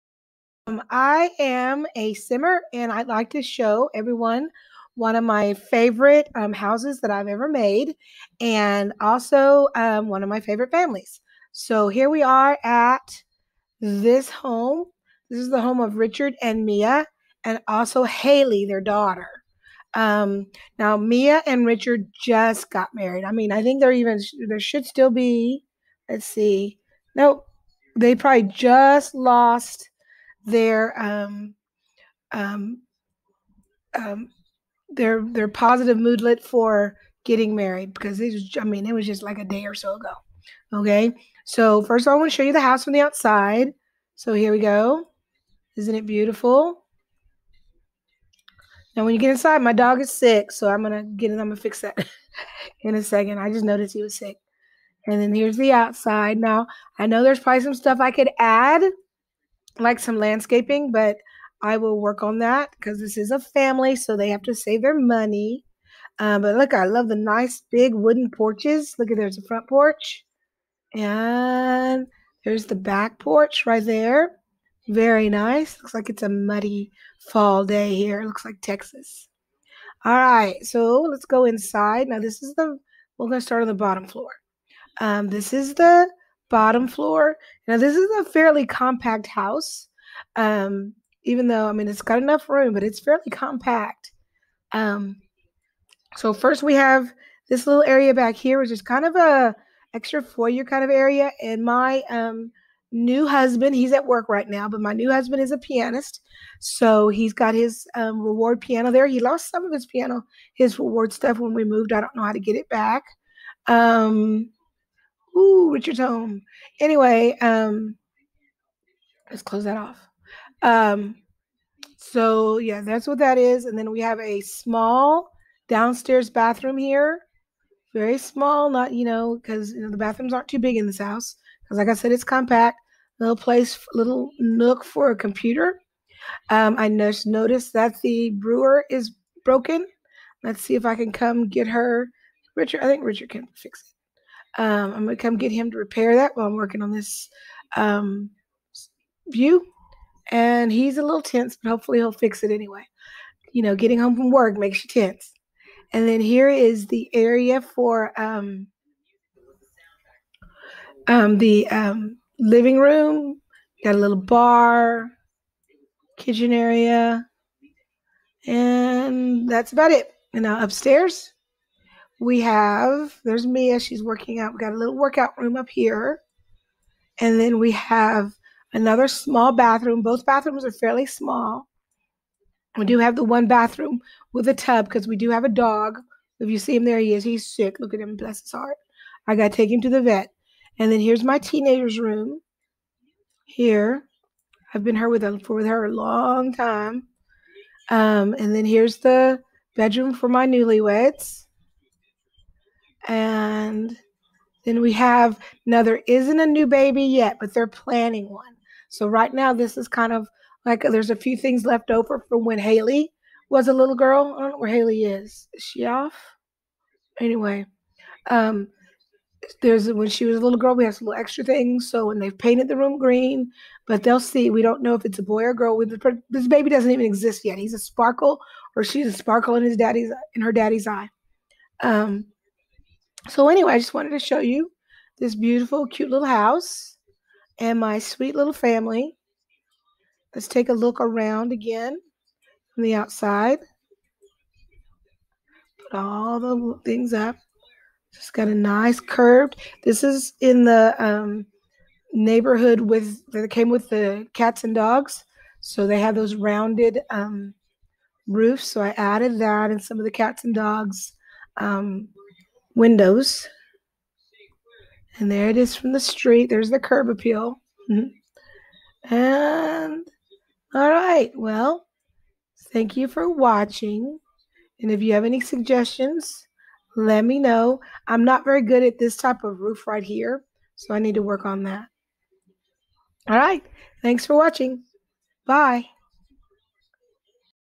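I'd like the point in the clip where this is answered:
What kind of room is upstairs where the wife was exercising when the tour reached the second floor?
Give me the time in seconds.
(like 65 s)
174 s.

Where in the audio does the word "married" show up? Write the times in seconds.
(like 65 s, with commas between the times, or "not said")
22 s, 37 s.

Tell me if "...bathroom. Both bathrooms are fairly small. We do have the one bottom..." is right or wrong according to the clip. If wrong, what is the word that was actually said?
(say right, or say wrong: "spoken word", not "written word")
wrong: "bathroom", not "bottom".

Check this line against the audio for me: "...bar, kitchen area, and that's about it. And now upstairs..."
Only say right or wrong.
right.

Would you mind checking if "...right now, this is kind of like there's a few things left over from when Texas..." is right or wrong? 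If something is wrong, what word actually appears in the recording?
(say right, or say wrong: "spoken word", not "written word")
wrong: "Haley", not "Texas".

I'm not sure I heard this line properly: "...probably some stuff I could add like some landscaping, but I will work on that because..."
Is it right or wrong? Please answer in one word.
right.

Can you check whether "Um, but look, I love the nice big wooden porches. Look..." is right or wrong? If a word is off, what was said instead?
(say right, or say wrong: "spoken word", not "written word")
right.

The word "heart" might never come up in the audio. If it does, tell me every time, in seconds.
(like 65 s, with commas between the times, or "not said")
188 s.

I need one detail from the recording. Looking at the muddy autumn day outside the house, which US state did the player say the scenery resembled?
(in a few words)
Texas.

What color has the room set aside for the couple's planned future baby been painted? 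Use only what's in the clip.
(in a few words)
Green.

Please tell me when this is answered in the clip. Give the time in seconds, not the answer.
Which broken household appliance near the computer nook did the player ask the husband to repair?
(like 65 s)
138 s.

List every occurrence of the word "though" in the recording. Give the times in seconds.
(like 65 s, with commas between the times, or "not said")
91 s.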